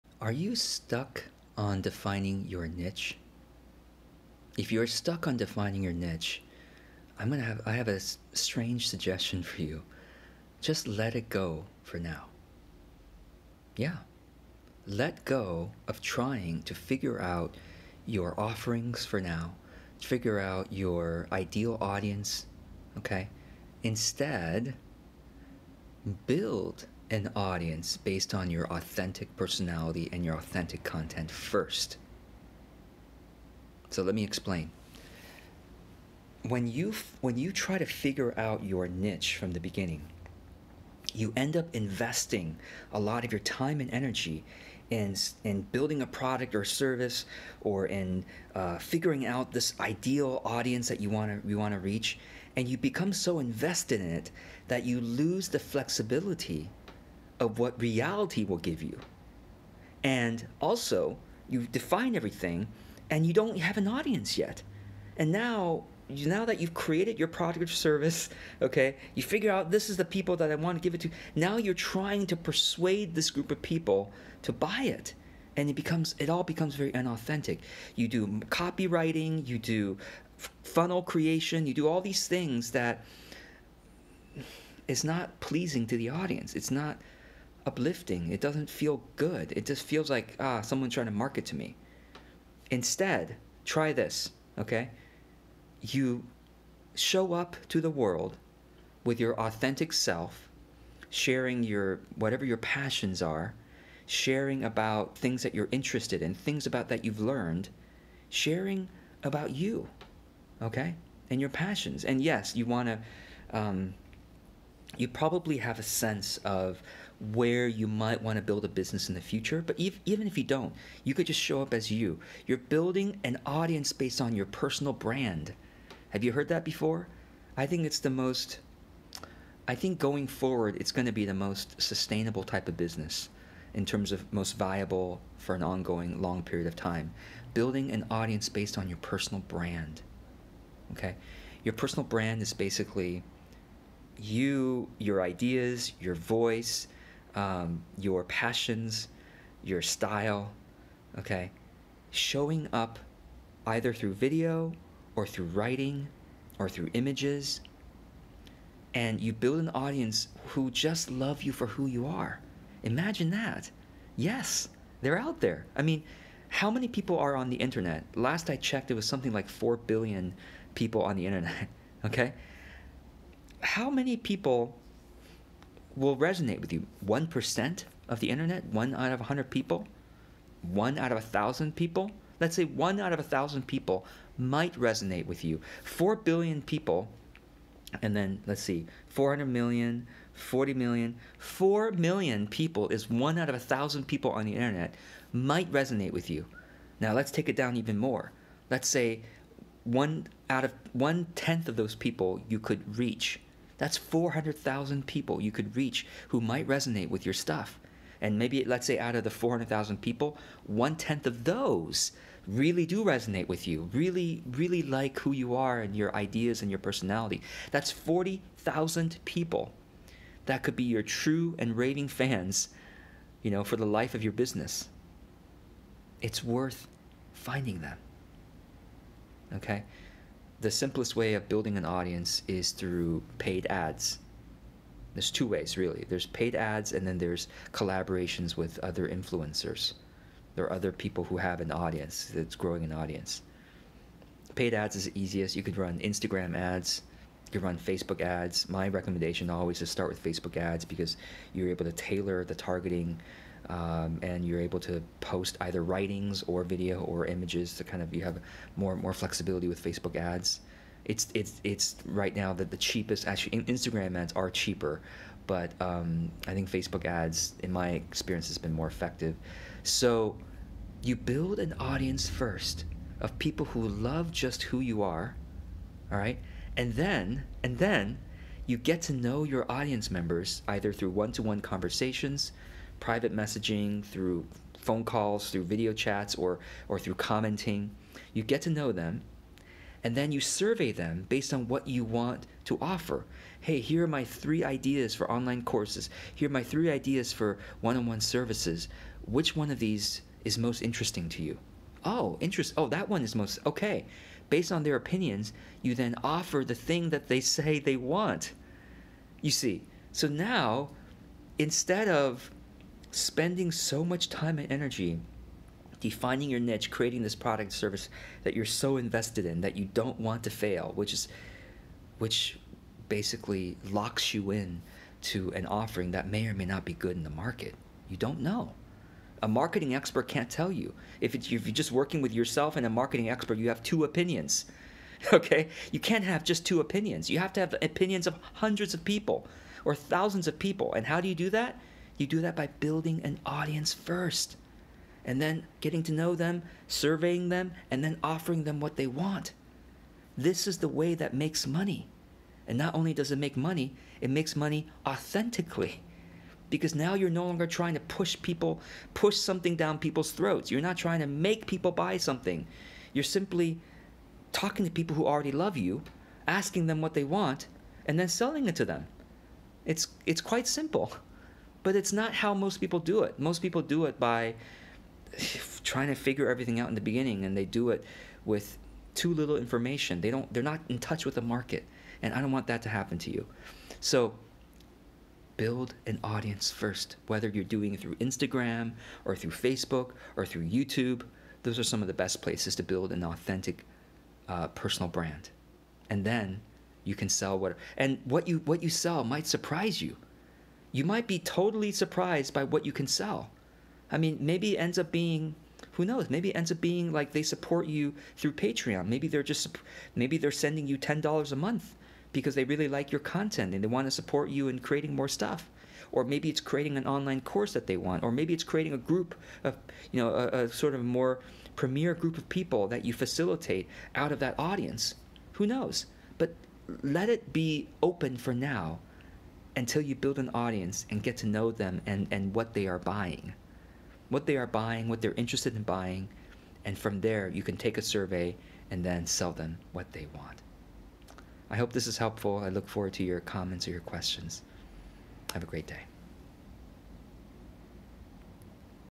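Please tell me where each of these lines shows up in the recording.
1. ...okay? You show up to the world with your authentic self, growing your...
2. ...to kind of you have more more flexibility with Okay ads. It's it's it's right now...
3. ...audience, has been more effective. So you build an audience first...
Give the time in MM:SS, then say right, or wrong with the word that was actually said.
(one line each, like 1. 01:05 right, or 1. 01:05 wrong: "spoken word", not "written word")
1. 01:34 wrong: "sharing", not "growing"
2. 04:17 wrong: "Facebook", not "Okay"
3. 04:27 wrong: "experience", not "audience".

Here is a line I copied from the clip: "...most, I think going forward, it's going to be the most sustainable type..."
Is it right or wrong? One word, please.
right.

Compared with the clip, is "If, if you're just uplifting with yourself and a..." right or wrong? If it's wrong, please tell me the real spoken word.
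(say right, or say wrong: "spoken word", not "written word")
wrong: "working", not "uplifting".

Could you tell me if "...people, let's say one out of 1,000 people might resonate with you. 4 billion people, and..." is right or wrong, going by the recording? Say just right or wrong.
right.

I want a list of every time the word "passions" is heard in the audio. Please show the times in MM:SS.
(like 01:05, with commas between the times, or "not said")
01:42, 01:51, 02:28.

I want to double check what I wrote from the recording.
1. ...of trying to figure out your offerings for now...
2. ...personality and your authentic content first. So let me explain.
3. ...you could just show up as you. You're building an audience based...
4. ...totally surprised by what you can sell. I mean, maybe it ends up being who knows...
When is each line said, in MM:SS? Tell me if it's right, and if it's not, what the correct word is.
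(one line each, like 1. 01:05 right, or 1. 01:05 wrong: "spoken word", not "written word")
1. 00:15 right
2. 00:29 right
3. 02:01 right
4. 06:41 right.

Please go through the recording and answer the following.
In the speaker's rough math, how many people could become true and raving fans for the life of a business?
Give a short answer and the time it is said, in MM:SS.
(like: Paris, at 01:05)
40,000, at 03:37.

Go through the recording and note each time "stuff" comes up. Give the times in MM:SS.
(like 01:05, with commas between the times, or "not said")
03:27, 06:55.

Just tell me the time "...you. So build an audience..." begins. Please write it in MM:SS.
06:23.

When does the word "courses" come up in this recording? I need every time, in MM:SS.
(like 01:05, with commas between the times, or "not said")
04:55, 06:57.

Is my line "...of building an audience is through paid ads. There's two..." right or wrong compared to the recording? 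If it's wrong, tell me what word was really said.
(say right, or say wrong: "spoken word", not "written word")
right.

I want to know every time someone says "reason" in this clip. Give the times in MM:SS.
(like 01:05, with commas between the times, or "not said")
not said.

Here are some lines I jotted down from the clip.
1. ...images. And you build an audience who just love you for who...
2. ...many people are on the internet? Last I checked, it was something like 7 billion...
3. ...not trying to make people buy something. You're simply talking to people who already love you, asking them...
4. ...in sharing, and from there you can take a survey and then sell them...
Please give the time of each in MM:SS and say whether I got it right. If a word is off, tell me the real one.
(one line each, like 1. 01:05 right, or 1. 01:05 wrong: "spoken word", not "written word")
1. 02:36 right
2. 02:46 wrong: "4", not "7"
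3. 06:00 right
4. 07:15 wrong: "buying", not "sharing".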